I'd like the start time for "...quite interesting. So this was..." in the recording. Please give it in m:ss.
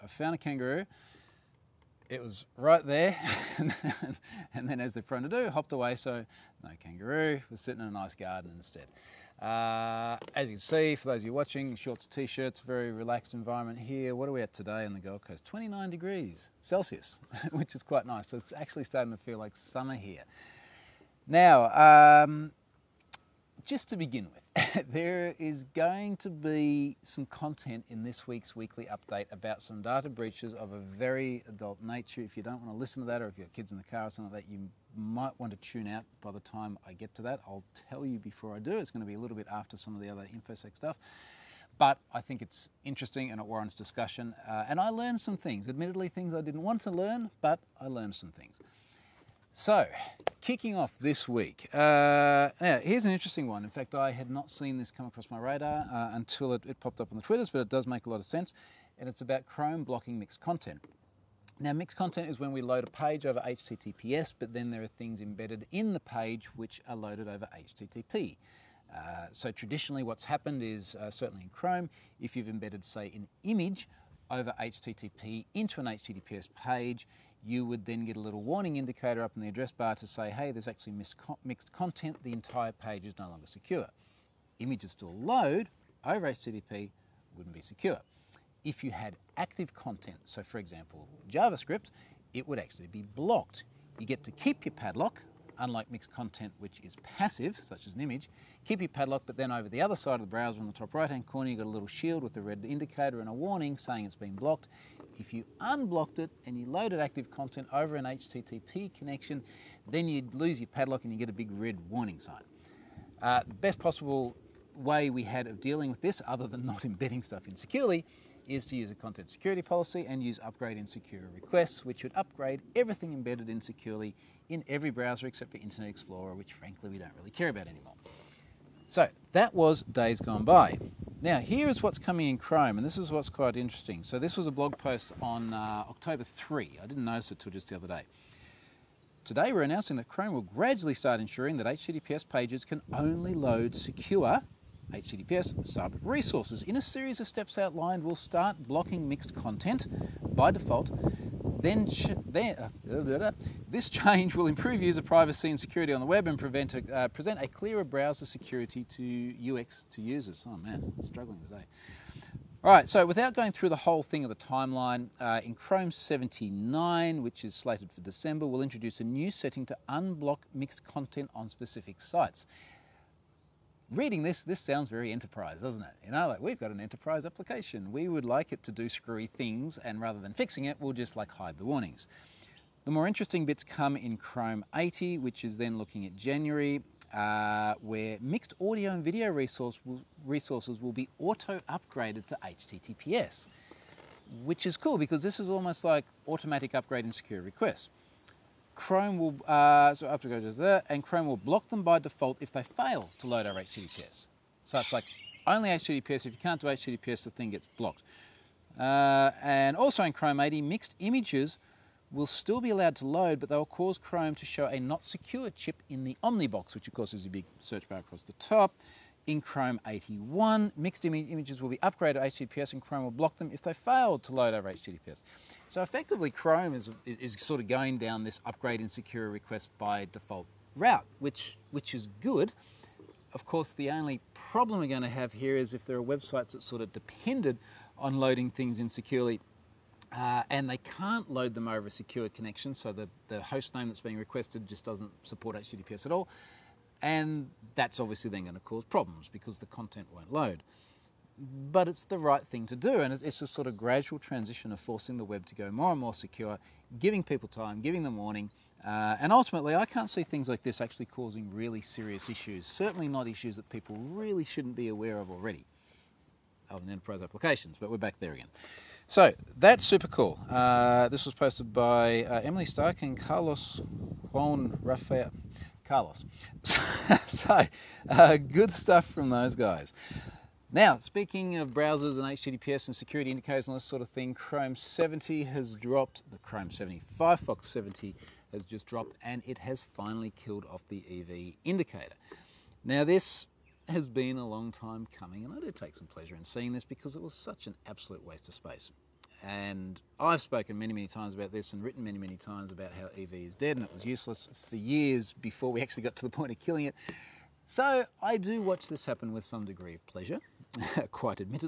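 2:13.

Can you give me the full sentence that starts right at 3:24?
So it's like only HTTPS, if you can't do HTTPS, the thing gets blocked.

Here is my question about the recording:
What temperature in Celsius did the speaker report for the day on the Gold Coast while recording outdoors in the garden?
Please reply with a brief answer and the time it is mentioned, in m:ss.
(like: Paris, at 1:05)
29 degrees, at 0:15.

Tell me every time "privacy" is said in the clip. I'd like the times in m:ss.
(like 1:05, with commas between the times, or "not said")
2:35.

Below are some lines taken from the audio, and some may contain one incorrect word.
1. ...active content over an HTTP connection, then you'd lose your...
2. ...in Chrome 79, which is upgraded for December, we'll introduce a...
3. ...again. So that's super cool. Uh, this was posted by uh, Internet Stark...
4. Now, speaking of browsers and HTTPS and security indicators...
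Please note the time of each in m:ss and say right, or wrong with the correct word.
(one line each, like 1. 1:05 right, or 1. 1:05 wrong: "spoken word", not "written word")
1. 1:47 right
2. 2:45 wrong: "slated", not "upgraded"
3. 4:28 wrong: "Emily", not "Internet"
4. 4:40 right.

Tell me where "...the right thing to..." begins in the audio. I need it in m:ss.
4:12.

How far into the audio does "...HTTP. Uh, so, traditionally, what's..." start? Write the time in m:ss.
1:07.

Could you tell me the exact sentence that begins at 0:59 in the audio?
And it's about Chrome blocking mixed content.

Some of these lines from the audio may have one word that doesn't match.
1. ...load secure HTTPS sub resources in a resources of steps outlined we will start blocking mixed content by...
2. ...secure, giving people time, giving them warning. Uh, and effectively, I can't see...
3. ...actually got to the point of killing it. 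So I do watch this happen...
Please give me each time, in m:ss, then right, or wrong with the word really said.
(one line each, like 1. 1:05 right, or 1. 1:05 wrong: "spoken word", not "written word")
1. 2:23 wrong: "series", not "resources"
2. 4:16 wrong: "ultimately", not "effectively"
3. 5:05 right.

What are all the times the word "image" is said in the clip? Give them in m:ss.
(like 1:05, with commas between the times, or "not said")
1:13, 1:24, 1:38, 3:31, 3:41.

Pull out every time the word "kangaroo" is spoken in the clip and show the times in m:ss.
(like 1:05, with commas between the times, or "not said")
0:00, 0:06.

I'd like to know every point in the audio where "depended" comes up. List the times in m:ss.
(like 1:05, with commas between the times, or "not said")
3:56.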